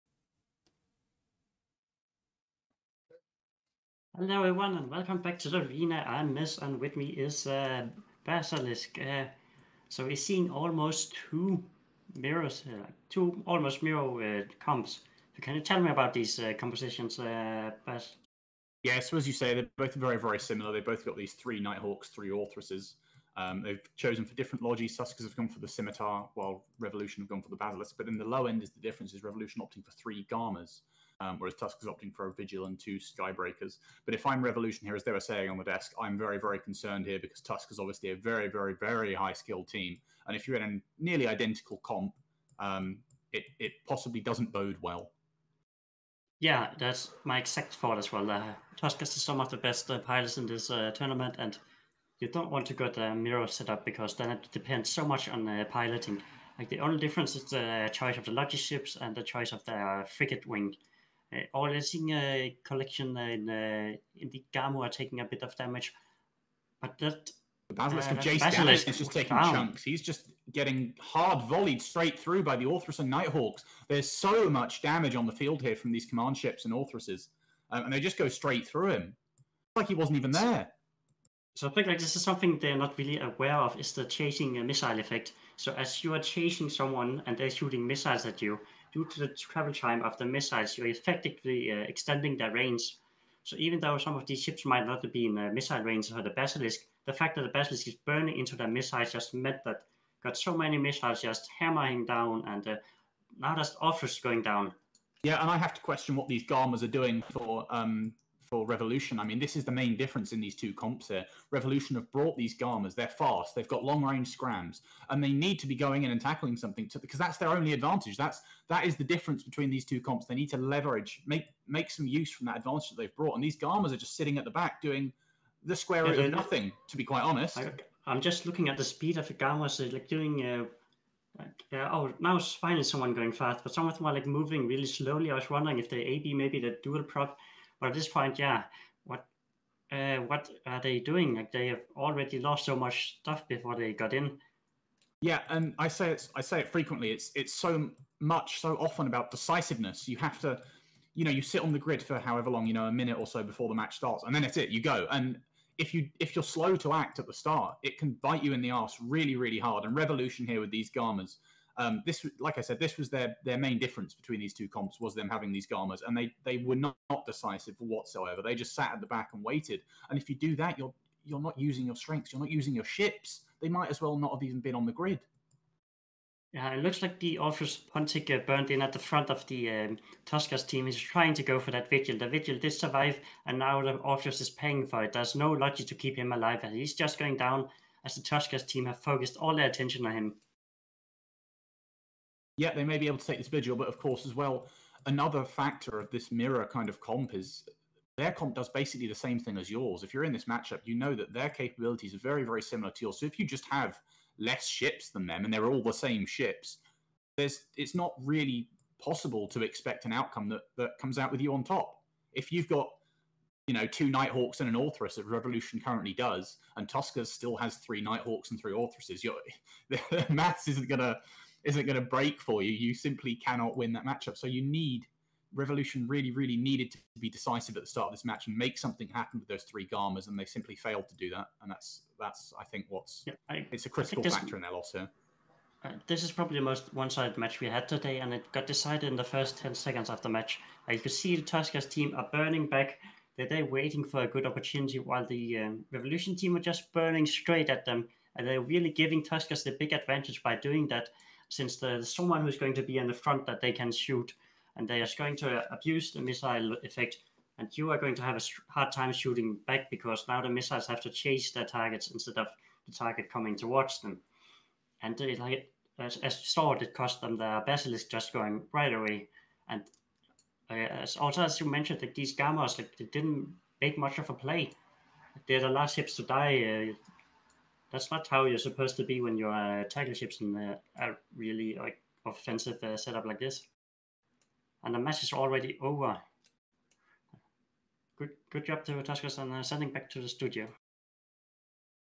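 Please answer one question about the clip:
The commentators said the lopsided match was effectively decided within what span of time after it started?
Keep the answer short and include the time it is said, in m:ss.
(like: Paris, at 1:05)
first 10 seconds, at 3:59.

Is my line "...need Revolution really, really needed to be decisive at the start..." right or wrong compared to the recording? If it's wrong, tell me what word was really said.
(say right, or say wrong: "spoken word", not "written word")
right.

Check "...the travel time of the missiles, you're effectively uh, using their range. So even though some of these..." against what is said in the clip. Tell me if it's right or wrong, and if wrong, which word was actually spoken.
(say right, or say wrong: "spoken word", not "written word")
wrong: "extending", not "using".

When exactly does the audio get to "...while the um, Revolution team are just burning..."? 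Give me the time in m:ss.
4:04.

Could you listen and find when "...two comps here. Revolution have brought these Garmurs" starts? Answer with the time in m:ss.
1:50.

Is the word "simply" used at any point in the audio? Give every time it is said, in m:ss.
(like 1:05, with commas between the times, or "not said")
3:42, 3:50.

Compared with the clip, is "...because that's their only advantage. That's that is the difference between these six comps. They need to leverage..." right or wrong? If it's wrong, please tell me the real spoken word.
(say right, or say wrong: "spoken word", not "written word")
wrong: "two", not "six".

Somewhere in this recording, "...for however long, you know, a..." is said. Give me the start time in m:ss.
2:32.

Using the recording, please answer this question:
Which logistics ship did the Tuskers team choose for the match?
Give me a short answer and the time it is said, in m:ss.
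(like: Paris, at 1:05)
Scimitar, at 0:25.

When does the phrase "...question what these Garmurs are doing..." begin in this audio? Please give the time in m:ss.
1:45.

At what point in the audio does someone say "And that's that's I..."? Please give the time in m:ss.
3:51.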